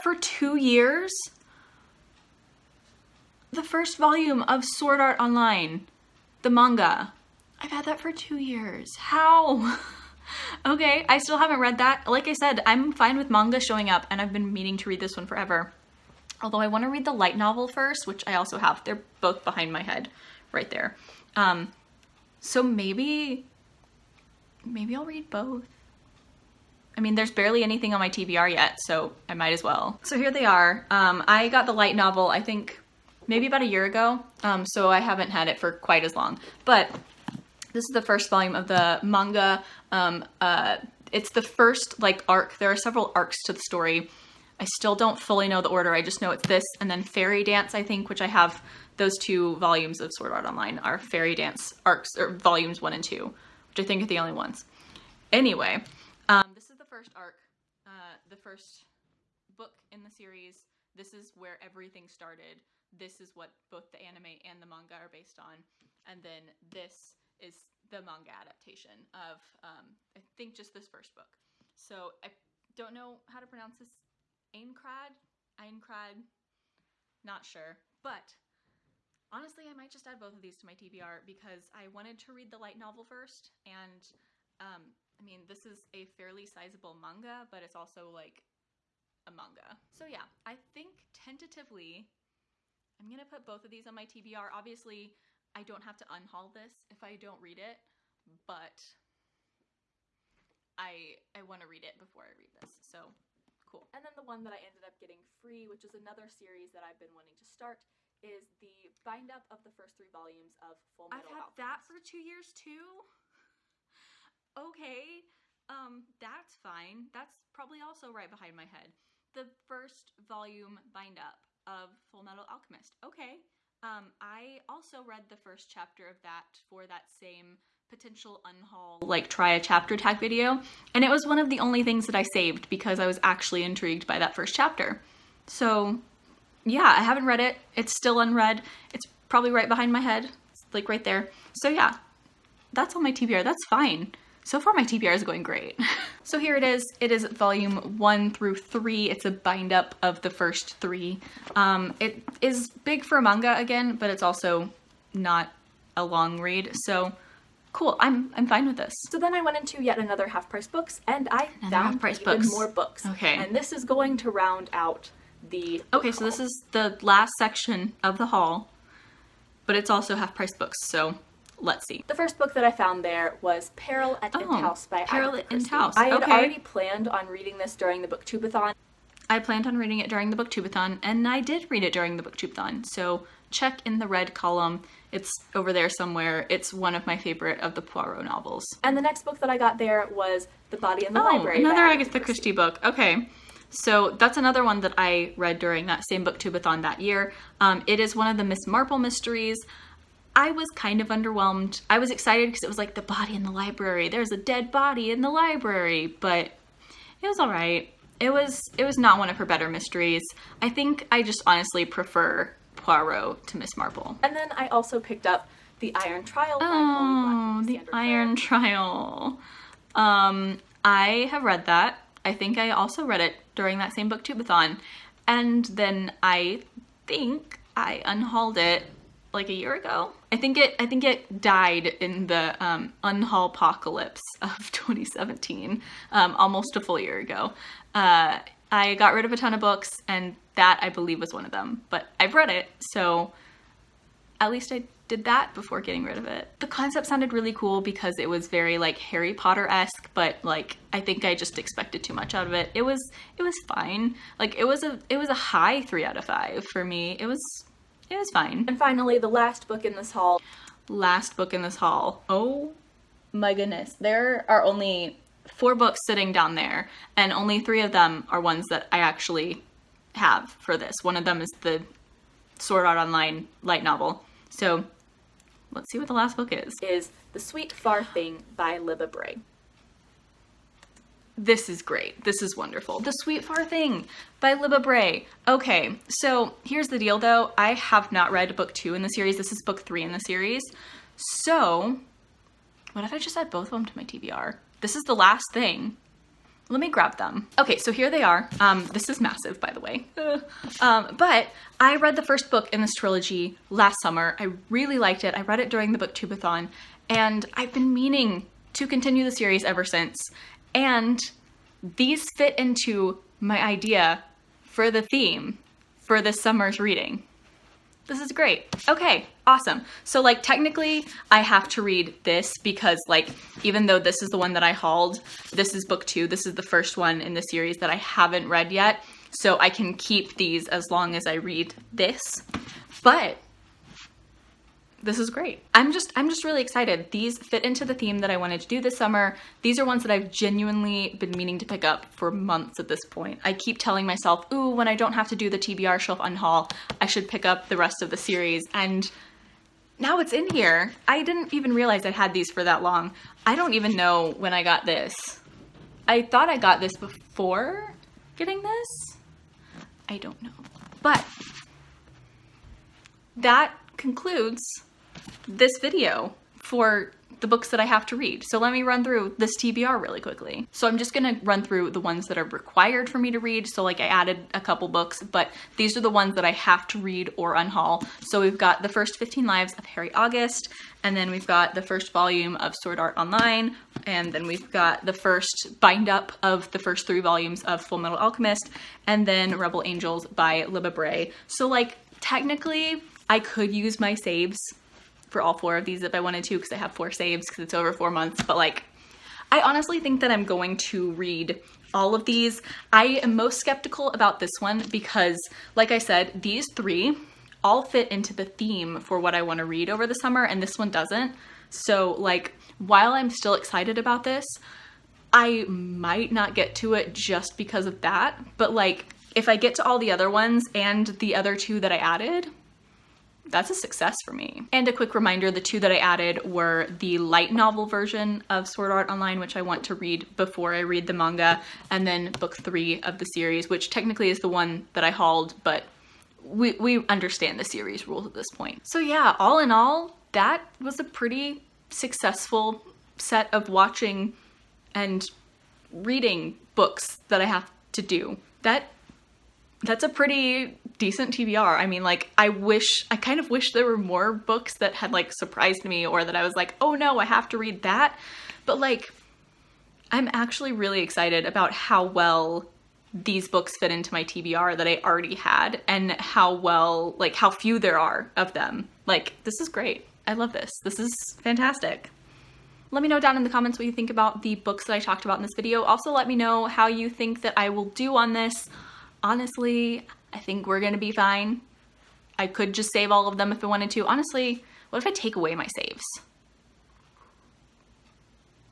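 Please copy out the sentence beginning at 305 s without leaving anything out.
I read it during the booktubeathon, and I've been meaning to continue the series ever since.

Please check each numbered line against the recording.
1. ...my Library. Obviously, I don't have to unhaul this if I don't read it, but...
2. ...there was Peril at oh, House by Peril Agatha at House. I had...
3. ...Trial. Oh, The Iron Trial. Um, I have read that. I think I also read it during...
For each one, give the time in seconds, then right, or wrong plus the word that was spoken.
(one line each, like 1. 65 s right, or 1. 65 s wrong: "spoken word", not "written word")
1. 93 s wrong: "TBR", not "Library"
2. 173 s right
3. 216 s right.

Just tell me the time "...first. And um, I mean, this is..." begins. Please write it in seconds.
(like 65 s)
83 s.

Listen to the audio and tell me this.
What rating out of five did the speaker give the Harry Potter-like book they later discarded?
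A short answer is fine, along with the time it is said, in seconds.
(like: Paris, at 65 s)
high 3, at 255 s.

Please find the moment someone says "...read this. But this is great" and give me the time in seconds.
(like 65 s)
331 s.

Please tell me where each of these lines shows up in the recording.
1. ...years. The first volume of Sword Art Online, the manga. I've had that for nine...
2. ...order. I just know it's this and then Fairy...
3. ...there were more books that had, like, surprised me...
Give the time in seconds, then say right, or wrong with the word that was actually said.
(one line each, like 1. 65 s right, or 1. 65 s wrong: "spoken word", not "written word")
1. 0 s wrong: "two", not "nine"
2. 45 s right
3. 453 s right.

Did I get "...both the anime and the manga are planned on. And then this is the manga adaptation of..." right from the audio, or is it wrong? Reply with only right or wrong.
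wrong.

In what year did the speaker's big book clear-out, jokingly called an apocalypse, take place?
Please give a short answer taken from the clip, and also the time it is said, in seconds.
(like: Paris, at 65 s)
2017, at 234 s.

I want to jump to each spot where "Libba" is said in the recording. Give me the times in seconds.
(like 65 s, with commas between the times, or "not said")
278 s, 284 s, 390 s.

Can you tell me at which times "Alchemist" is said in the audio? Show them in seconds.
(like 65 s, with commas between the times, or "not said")
111 s, 122 s, 388 s.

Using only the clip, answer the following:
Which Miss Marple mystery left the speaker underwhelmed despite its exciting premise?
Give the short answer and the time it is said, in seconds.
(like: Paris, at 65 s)
The Body in the Library, at 190 s.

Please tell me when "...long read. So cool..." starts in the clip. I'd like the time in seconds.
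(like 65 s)
156 s.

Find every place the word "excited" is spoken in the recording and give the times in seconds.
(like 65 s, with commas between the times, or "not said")
202 s, 336 s, 413 s, 460 s.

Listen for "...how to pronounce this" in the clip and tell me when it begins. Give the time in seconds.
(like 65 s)
73 s.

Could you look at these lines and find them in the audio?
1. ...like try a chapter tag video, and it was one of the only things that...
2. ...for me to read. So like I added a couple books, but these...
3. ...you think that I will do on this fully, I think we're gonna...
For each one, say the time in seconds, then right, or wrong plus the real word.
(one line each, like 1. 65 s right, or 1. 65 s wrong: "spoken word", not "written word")
1. 129 s right
2. 373 s right
3. 476 s wrong: "honestly", not "fully".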